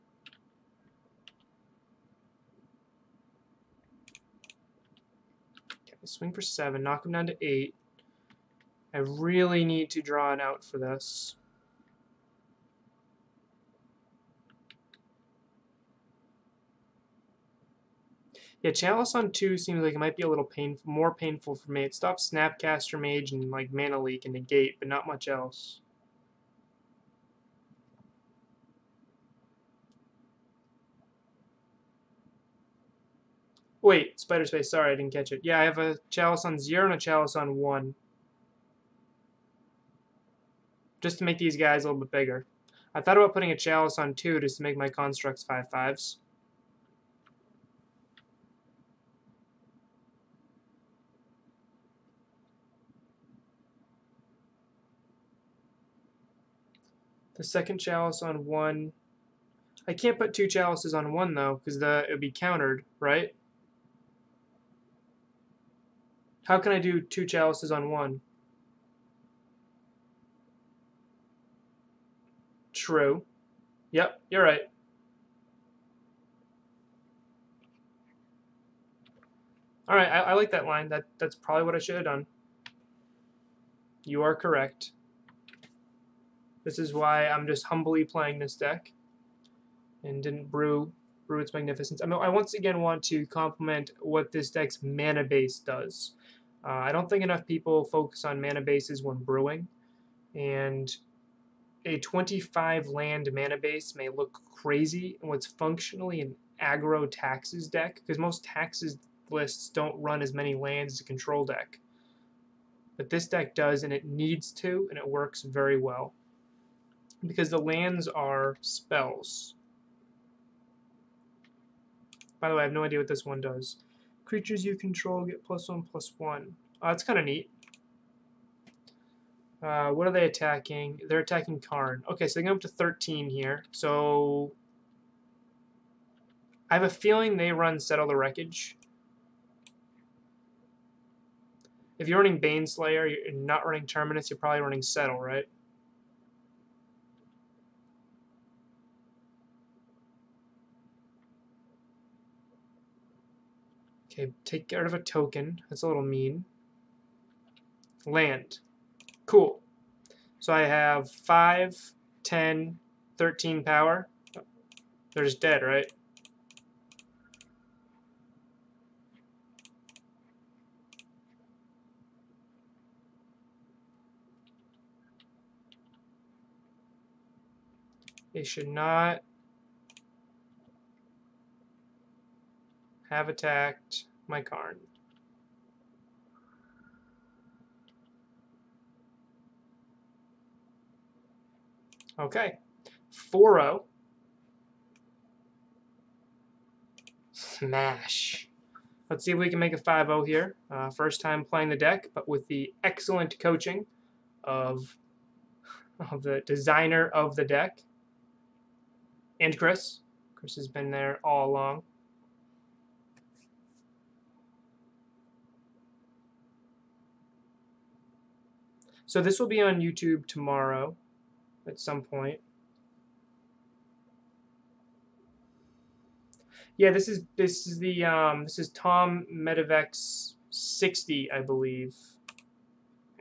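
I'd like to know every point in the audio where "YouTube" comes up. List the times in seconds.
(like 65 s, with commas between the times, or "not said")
219 s.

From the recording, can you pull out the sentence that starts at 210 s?
Chris has been there all along.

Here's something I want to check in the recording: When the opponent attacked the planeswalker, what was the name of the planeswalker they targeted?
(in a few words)
Karn.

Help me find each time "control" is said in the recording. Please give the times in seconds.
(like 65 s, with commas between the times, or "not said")
111 s, 124 s.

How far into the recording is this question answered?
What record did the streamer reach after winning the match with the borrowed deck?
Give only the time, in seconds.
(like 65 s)
193 s.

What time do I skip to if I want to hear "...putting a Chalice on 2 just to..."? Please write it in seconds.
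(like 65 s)
43 s.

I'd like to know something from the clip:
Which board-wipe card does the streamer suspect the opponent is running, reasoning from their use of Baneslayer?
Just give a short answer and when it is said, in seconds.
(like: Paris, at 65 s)
Settle the Wreckage, at 137 s.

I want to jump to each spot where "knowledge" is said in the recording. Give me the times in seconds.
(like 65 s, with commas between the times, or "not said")
not said.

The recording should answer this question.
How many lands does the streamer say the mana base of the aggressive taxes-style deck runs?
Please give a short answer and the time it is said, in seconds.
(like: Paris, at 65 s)
25, at 101 s.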